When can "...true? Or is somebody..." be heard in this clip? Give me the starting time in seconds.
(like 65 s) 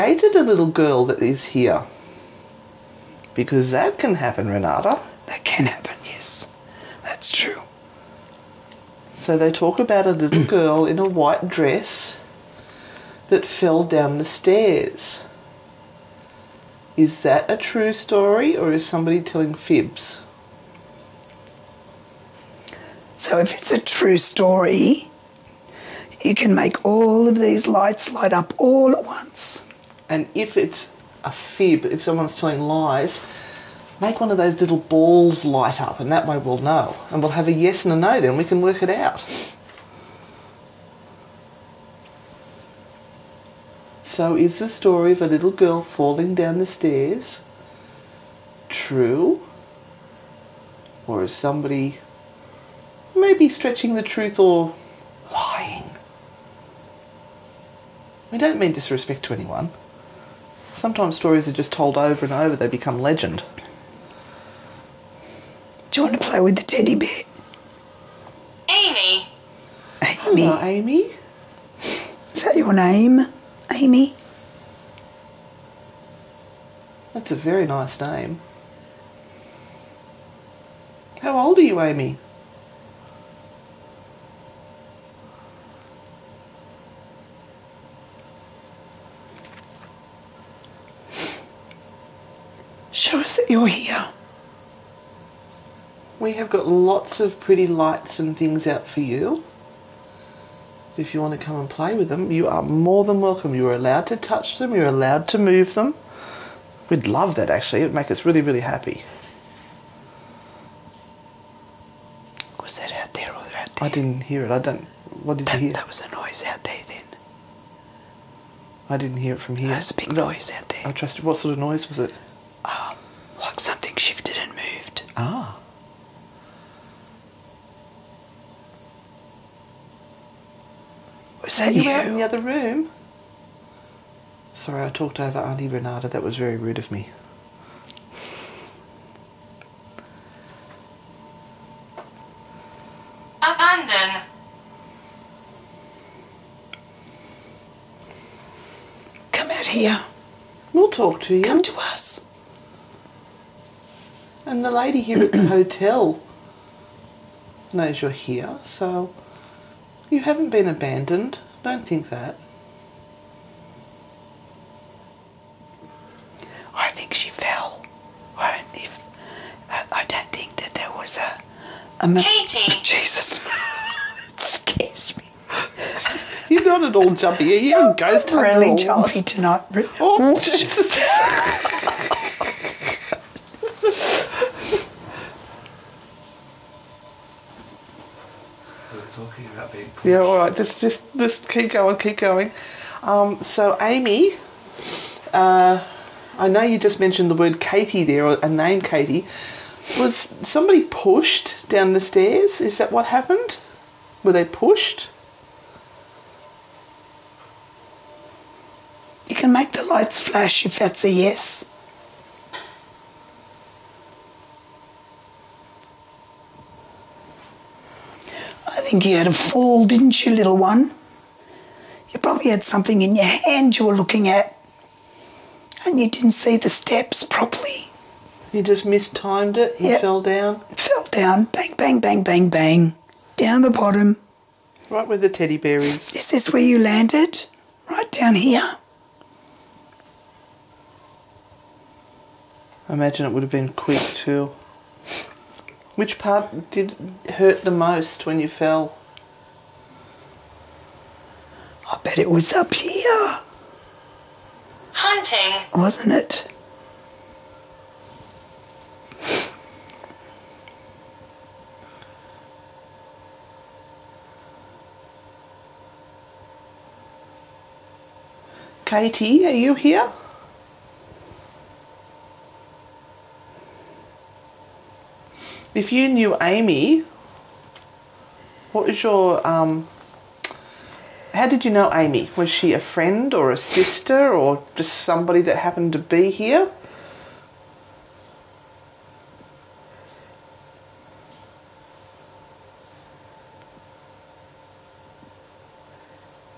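48 s.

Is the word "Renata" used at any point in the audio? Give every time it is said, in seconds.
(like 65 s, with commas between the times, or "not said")
4 s, 135 s.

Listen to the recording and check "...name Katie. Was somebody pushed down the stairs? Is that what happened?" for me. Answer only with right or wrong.
right.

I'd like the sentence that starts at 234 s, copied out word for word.
Right where the teddy bear is.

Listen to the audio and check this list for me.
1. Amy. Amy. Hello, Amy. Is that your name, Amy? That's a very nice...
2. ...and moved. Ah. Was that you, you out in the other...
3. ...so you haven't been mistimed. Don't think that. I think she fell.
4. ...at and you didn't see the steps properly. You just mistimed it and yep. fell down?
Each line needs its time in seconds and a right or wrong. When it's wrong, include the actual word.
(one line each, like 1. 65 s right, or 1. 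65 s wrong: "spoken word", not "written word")
1. 68 s right
2. 124 s right
3. 158 s wrong: "abandoned", not "mistimed"
4. 224 s right.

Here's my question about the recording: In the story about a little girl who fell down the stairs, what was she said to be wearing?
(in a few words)
White dress.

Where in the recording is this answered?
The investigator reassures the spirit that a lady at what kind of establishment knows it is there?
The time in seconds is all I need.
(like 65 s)
155 s.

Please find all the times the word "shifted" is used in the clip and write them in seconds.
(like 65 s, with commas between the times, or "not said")
123 s.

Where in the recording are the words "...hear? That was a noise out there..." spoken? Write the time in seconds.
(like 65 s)
115 s.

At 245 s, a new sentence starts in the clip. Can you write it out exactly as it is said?
Which part did hurt the most when you fell?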